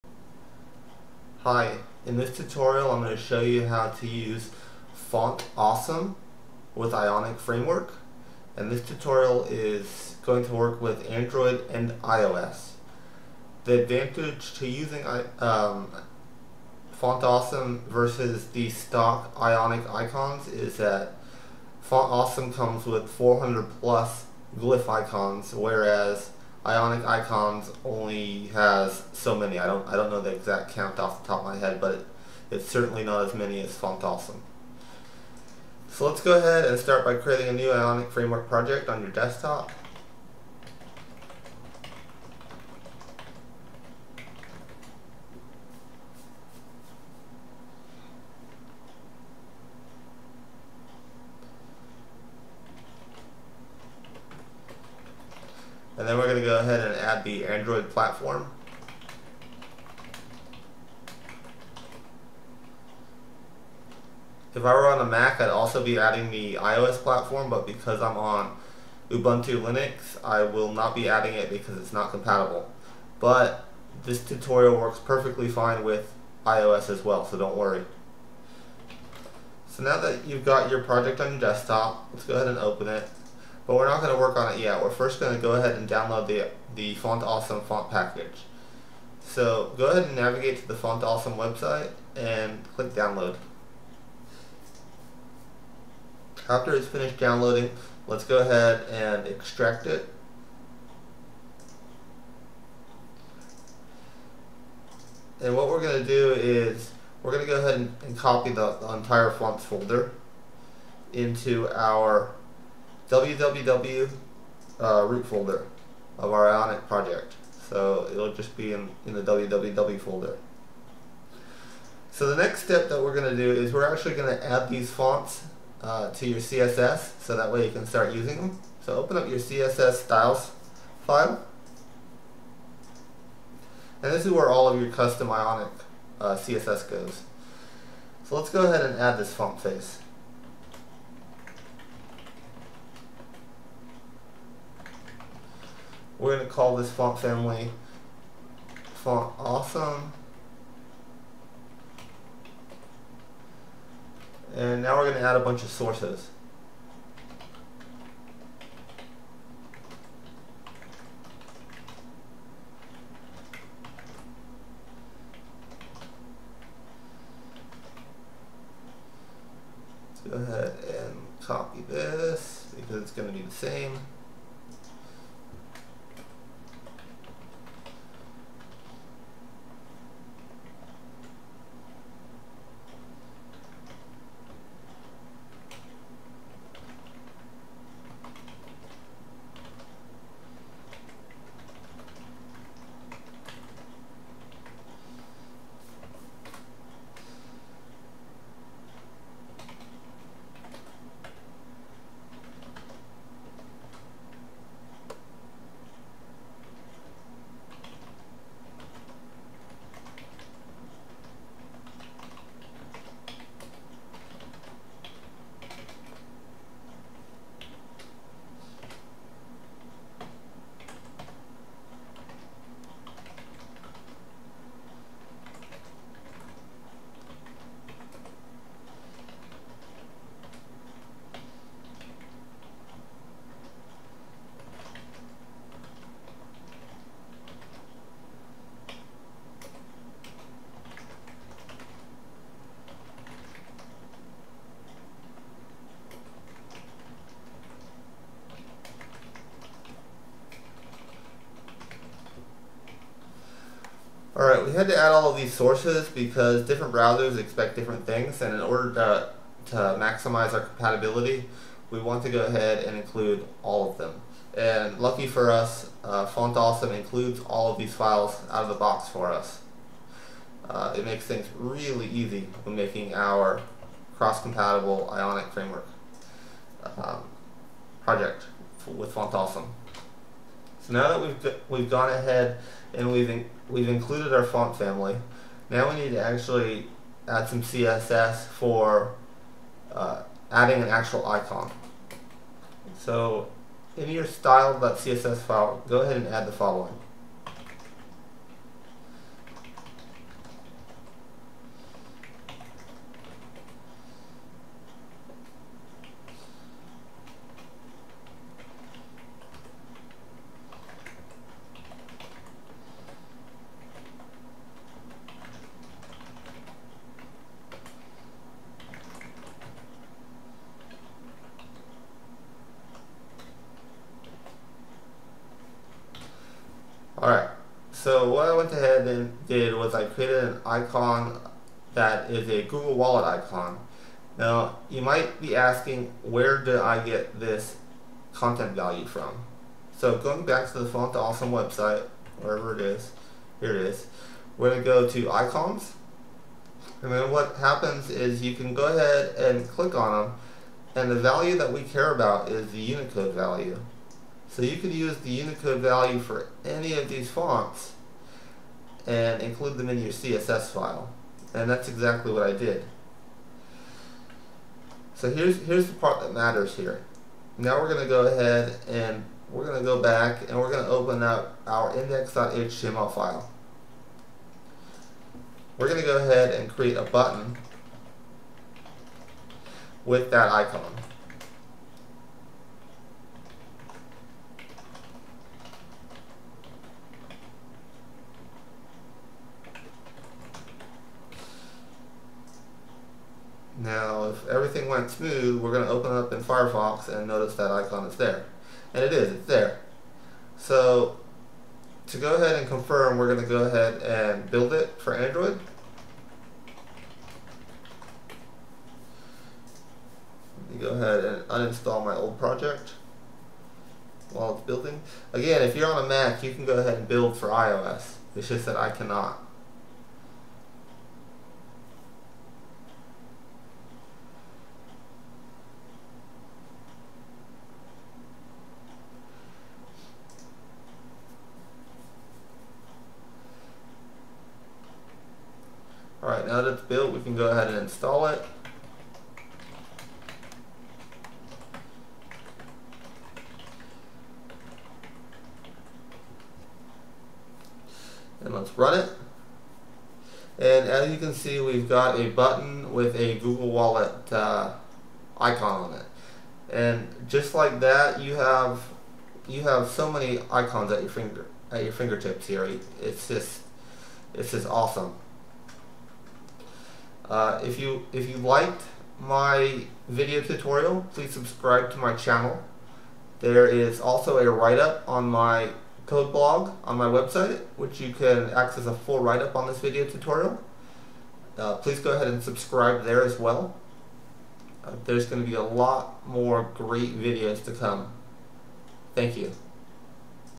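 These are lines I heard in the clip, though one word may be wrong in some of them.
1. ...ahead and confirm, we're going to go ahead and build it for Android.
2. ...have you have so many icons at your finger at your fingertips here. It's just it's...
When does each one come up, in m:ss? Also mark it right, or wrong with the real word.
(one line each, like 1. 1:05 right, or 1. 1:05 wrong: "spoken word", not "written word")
1. 6:42 right
2. 7:38 right.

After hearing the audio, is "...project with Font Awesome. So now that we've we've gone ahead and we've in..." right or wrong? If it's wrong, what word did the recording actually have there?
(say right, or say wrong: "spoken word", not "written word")
right.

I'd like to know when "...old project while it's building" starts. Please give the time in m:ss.
6:52.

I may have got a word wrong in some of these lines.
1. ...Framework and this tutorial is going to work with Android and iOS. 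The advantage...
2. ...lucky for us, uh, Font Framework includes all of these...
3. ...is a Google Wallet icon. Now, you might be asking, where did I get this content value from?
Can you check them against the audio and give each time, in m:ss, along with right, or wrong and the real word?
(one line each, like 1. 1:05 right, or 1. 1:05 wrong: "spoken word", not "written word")
1. 0:07 right
2. 4:24 wrong: "Awesome", not "Framework"
3. 5:32 right.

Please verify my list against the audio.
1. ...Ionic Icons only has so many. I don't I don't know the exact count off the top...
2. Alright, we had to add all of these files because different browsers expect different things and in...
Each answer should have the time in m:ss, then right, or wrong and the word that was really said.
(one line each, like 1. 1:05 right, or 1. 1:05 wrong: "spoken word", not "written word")
1. 0:26 right
2. 4:14 wrong: "sources", not "files".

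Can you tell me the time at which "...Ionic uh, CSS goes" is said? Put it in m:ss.
2:15.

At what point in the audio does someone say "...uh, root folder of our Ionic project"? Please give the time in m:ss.
1:54.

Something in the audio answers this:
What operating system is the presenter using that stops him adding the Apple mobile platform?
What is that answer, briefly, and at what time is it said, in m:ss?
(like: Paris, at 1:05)
Ubuntu Linux, at 1:09.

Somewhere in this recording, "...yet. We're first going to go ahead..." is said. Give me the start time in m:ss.
1:24.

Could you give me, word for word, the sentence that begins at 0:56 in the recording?
then we're going to go ahead and add the Android platform.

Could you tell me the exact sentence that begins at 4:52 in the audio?
So in your style.css file, go ahead and add the following.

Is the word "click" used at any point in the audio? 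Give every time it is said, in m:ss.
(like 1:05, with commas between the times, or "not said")
1:32, 5:49.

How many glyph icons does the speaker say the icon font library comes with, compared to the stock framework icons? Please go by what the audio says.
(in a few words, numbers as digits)
400 plus.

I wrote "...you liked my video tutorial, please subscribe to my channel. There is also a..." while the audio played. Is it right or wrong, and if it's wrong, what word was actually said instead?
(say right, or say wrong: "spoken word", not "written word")
right.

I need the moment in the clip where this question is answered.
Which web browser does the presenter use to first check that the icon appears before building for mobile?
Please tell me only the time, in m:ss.
6:36.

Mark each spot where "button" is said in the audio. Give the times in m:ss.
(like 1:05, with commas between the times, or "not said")
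6:17, 7:32.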